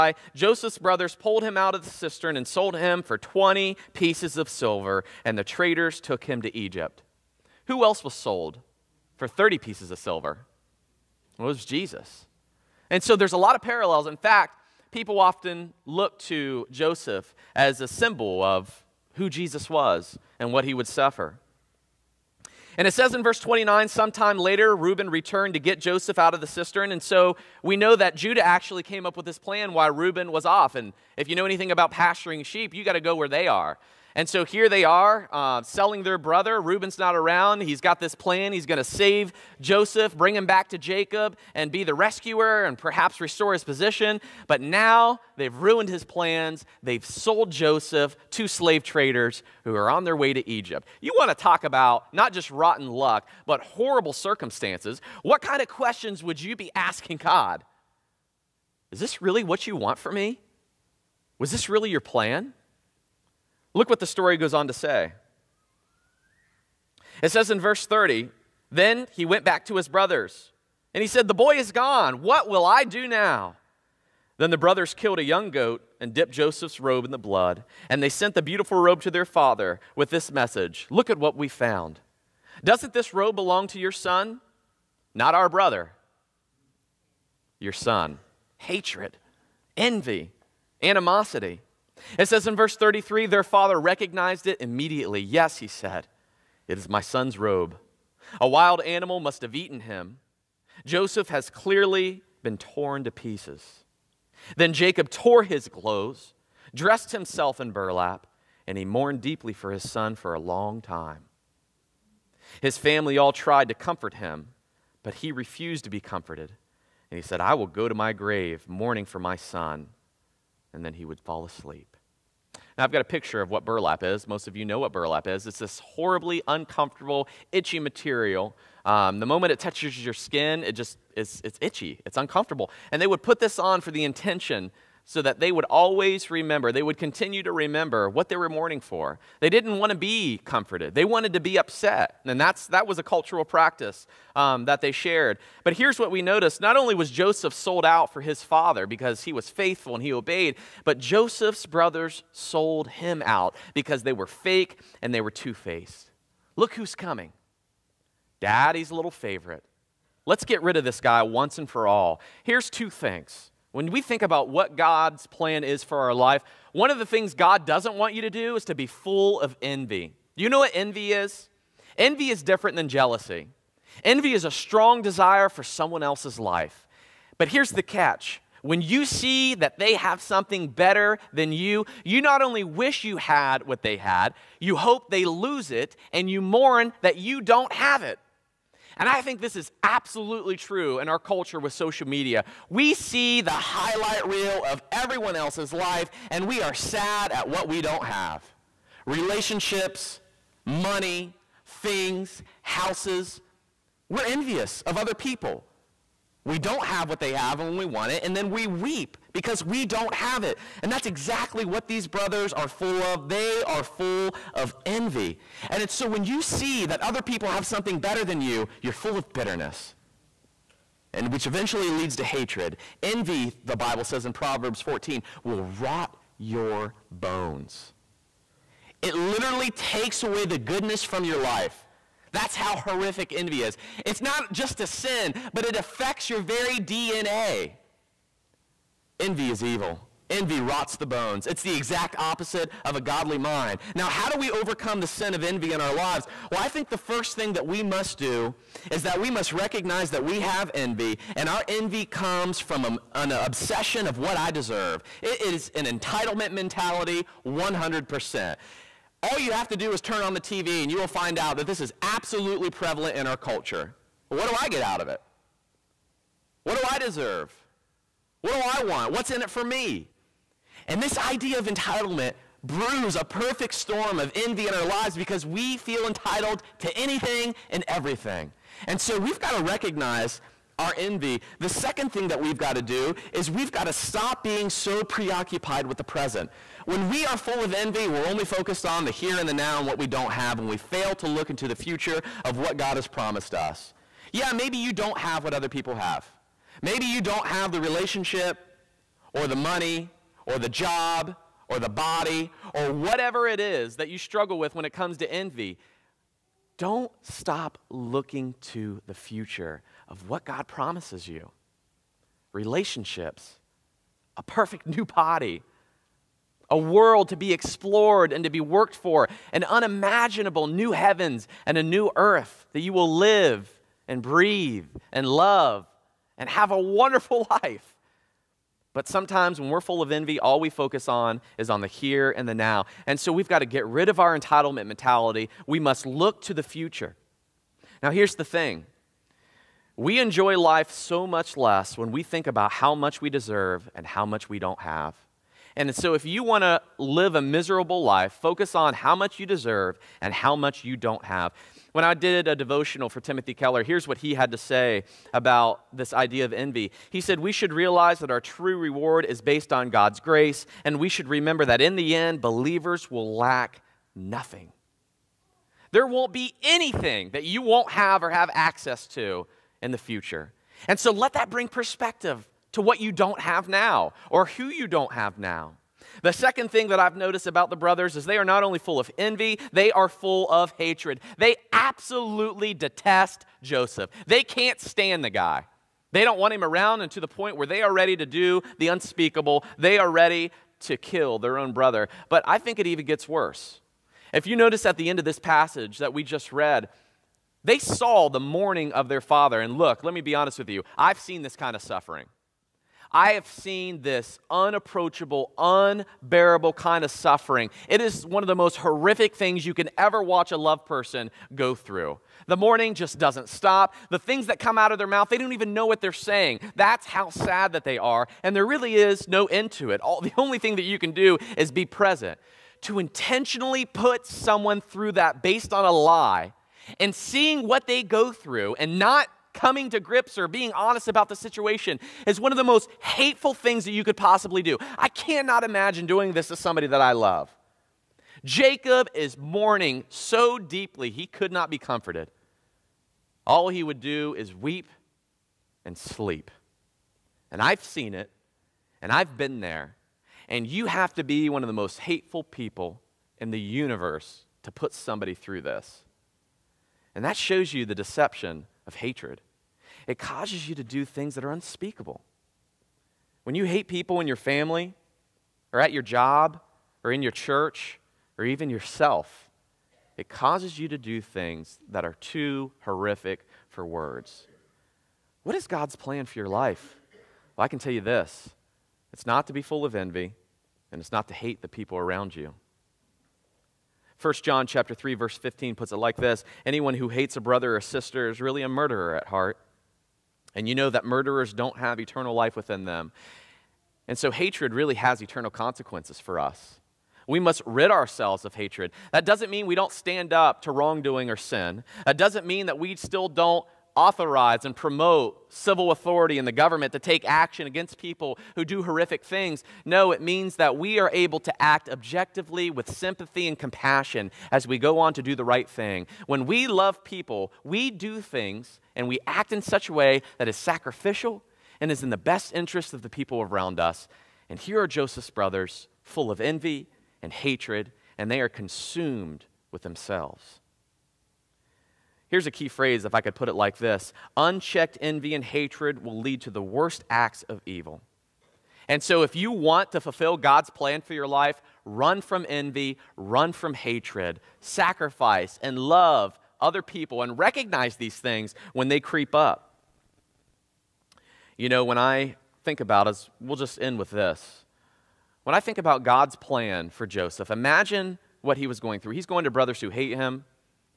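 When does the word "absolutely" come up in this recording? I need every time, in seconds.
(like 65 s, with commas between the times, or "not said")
189 s, 262 s, 381 s.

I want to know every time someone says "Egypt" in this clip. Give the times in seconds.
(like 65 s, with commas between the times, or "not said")
6 s, 50 s.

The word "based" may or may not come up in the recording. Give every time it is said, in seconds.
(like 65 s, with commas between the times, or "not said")
359 s, 425 s.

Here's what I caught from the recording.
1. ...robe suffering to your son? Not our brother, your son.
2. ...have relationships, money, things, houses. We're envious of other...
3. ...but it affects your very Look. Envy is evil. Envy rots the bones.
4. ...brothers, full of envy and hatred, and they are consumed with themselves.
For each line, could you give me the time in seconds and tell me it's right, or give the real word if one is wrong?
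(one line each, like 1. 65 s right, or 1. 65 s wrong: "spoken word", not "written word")
1. 83 s wrong: "belong", not "suffering"
2. 198 s right
3. 235 s wrong: "DNA", not "Look"
4. 525 s right.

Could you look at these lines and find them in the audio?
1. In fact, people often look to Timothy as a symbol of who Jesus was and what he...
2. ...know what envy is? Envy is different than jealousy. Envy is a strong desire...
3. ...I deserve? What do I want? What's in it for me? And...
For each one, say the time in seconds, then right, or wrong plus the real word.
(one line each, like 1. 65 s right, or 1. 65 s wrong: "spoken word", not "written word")
1. 14 s wrong: "Joseph", not "Timothy"
2. 170 s right
3. 266 s right.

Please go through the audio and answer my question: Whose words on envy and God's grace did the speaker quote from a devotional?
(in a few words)
Timothy Keller.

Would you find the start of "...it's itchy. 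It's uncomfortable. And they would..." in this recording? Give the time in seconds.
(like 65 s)
131 s.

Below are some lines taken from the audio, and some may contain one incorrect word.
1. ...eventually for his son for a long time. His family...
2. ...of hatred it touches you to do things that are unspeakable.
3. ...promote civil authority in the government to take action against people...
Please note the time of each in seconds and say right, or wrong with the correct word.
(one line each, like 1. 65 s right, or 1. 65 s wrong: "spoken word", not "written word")
1. 109 s wrong: "deeply", not "eventually"
2. 458 s wrong: "causes", not "touches"
3. 504 s right.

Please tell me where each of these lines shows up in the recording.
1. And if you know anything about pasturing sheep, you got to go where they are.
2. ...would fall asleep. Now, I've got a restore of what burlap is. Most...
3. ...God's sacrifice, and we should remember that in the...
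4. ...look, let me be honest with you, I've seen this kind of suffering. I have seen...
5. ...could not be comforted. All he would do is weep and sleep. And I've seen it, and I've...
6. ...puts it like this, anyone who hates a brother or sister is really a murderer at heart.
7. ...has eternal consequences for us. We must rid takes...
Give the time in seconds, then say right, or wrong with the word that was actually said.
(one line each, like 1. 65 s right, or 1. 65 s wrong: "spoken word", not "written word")
1. 30 s right
2. 121 s wrong: "picture", not "restore"
3. 359 s wrong: "grace", not "sacrifice"
4. 399 s right
5. 441 s right
6. 485 s right
7. 494 s wrong: "ourselves", not "takes".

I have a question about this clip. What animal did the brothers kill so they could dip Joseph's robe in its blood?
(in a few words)
A young goat.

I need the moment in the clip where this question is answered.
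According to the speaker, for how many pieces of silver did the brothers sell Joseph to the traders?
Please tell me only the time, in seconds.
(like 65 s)
3 s.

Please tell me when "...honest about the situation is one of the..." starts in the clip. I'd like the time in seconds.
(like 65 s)
430 s.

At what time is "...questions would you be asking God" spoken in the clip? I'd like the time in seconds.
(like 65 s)
55 s.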